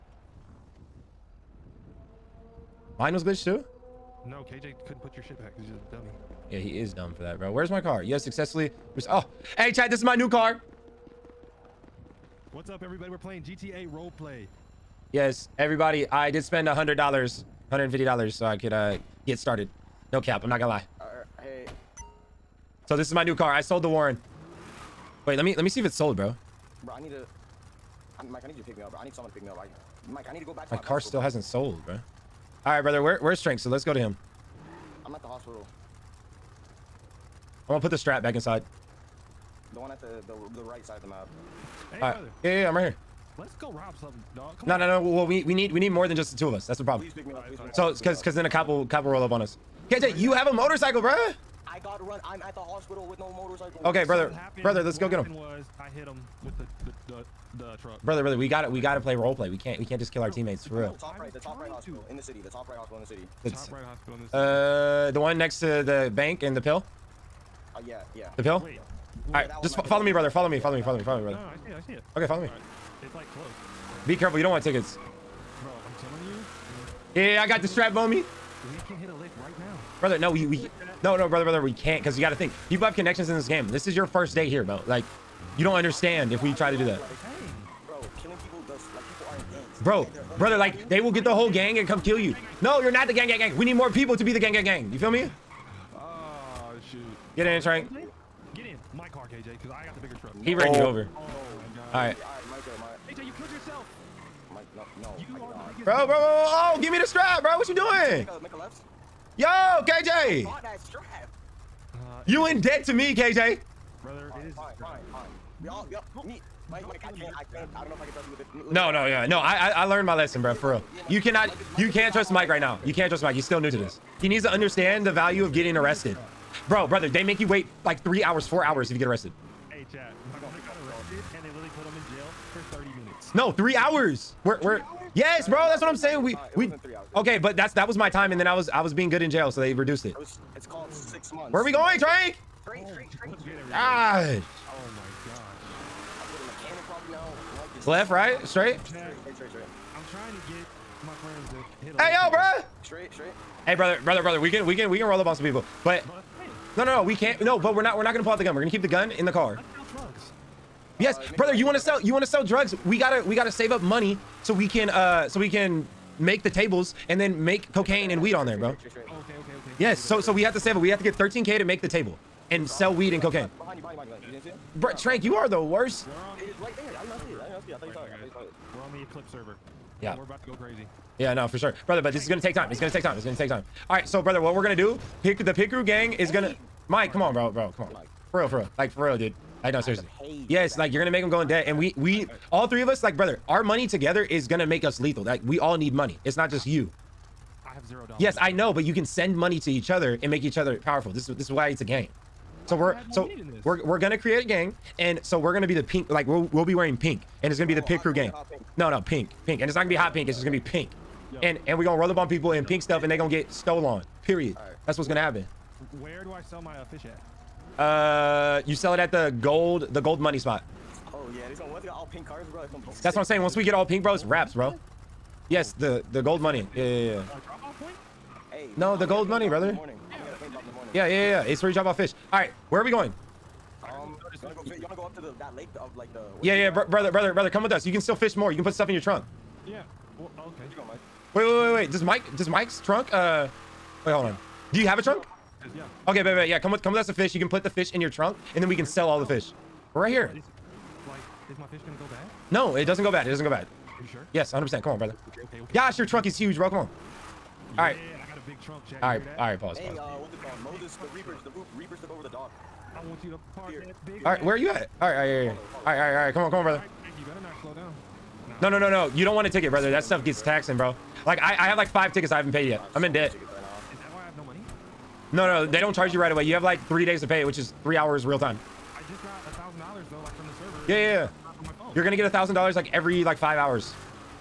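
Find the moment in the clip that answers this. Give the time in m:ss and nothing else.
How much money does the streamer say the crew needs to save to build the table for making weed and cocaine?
2:51.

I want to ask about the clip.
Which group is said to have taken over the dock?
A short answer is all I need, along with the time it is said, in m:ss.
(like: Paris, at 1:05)
The Reapers, at 4:21.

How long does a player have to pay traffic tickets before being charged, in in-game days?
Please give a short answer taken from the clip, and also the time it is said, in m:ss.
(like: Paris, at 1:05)
3 days, at 4:36.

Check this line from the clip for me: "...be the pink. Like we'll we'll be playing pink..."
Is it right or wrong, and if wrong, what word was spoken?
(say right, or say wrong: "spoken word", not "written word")
wrong: "wearing", not "playing".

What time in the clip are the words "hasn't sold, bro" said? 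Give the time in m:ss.
0:31.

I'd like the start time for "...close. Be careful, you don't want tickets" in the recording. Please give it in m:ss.
1:13.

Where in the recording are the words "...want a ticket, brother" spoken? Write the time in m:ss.
4:29.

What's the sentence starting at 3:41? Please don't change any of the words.
Oh yeah, this one once got all pink cars, bro.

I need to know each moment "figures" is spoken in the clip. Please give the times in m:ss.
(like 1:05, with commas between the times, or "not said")
not said.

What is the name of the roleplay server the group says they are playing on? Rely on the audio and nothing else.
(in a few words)
Eclipse.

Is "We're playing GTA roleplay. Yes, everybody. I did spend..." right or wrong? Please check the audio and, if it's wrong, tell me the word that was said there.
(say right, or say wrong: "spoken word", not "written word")
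right.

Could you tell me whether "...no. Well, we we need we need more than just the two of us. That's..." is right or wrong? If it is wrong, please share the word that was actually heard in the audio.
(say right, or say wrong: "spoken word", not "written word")
right.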